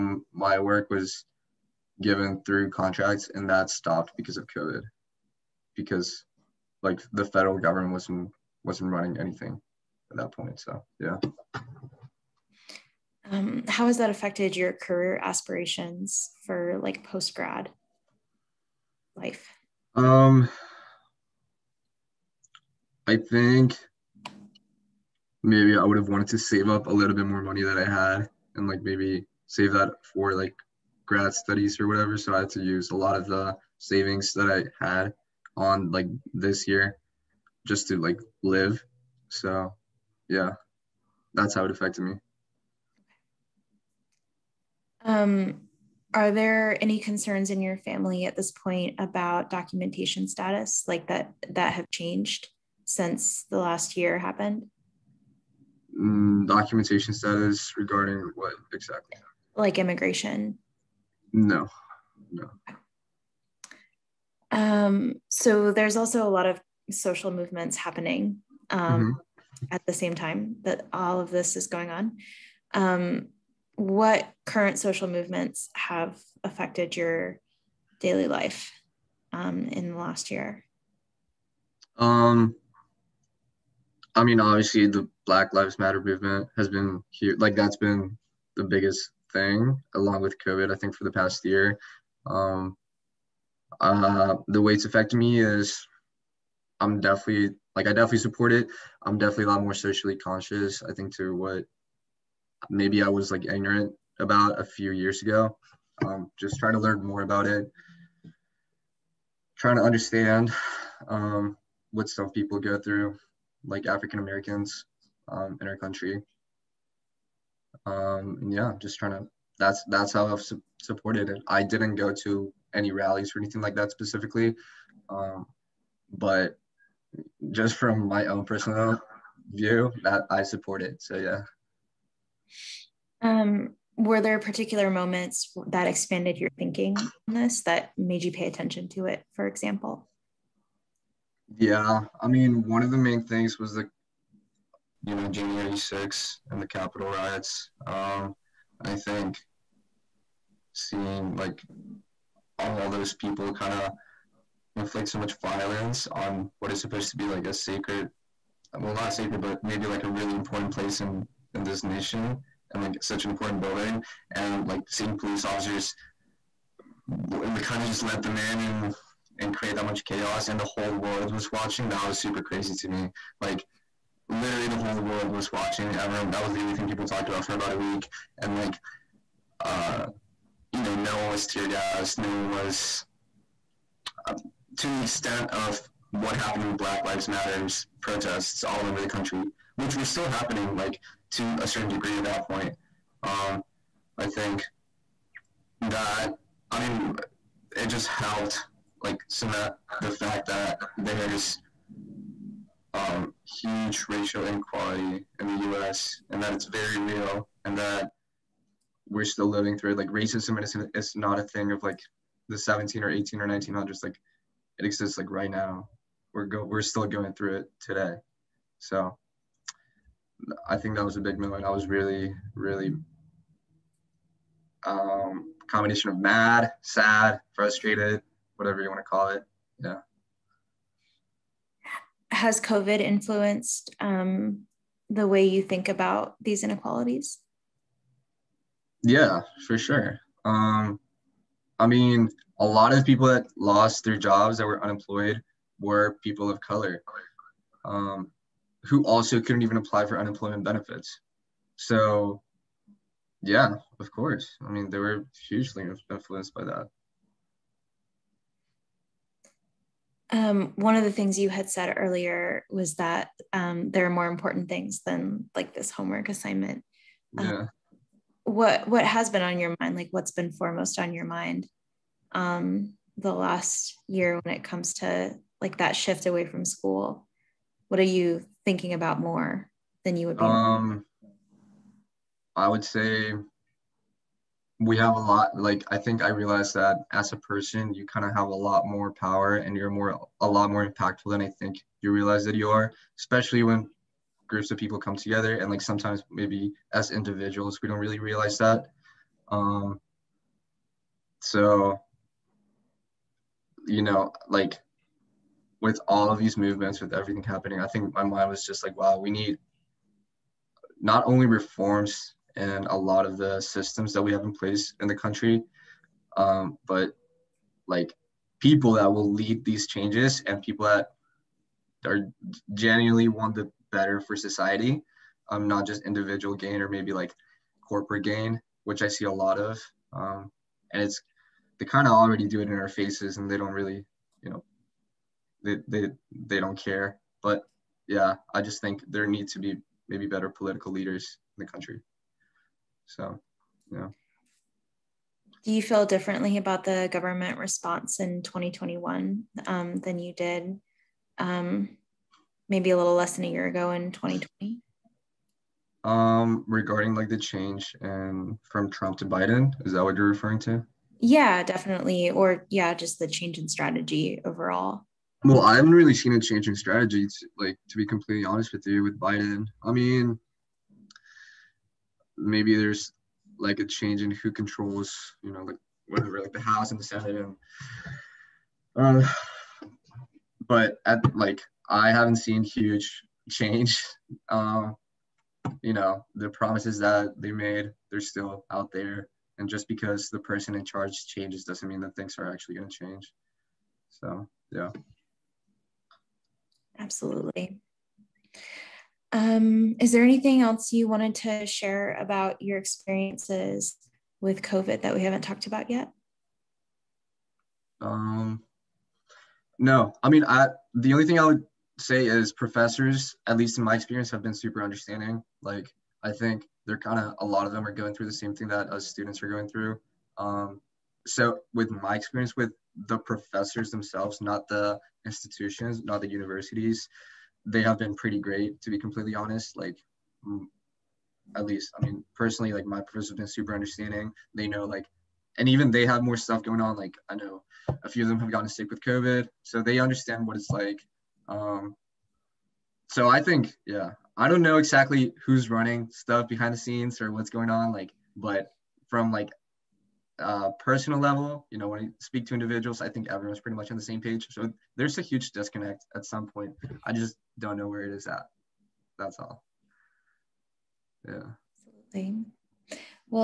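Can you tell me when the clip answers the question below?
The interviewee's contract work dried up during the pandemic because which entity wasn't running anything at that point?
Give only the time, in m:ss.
0:07.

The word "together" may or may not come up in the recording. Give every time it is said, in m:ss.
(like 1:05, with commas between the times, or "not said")
4:55.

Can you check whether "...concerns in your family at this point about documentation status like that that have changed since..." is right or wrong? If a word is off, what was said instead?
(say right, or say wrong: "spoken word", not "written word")
right.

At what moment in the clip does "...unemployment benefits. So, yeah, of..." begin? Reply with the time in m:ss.
4:10.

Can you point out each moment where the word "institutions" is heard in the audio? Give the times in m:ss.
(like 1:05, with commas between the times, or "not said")
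7:05.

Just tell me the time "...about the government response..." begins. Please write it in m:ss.
5:46.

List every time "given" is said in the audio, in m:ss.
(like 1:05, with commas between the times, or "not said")
0:02.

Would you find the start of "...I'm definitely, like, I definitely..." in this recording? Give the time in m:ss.
1:36.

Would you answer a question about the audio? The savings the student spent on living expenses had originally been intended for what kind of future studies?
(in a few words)
grad studies.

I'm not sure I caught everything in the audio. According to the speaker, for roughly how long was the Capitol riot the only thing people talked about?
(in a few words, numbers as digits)
about a week.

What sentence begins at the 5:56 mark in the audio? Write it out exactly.
Um, regarding like the change and from Trump to Biden, is that what you're referring to?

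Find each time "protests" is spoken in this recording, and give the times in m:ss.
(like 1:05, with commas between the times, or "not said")
3:08.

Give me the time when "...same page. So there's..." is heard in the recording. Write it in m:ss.
7:34.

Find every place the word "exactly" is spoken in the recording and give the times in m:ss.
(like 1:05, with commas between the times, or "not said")
0:58, 7:24.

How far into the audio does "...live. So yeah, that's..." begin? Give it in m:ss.
0:38.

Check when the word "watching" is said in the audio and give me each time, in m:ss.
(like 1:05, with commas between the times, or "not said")
2:51, 2:55.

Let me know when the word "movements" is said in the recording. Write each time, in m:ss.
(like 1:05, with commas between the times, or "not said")
1:07, 1:15, 1:26, 5:06.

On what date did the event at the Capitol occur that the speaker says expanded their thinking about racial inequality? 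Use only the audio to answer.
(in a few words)
January 6th.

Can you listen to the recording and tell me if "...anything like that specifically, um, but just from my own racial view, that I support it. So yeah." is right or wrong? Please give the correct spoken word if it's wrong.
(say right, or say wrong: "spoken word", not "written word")
wrong: "personal", not "racial".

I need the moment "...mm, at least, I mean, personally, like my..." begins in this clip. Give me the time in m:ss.
7:10.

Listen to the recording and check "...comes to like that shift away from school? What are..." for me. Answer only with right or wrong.
right.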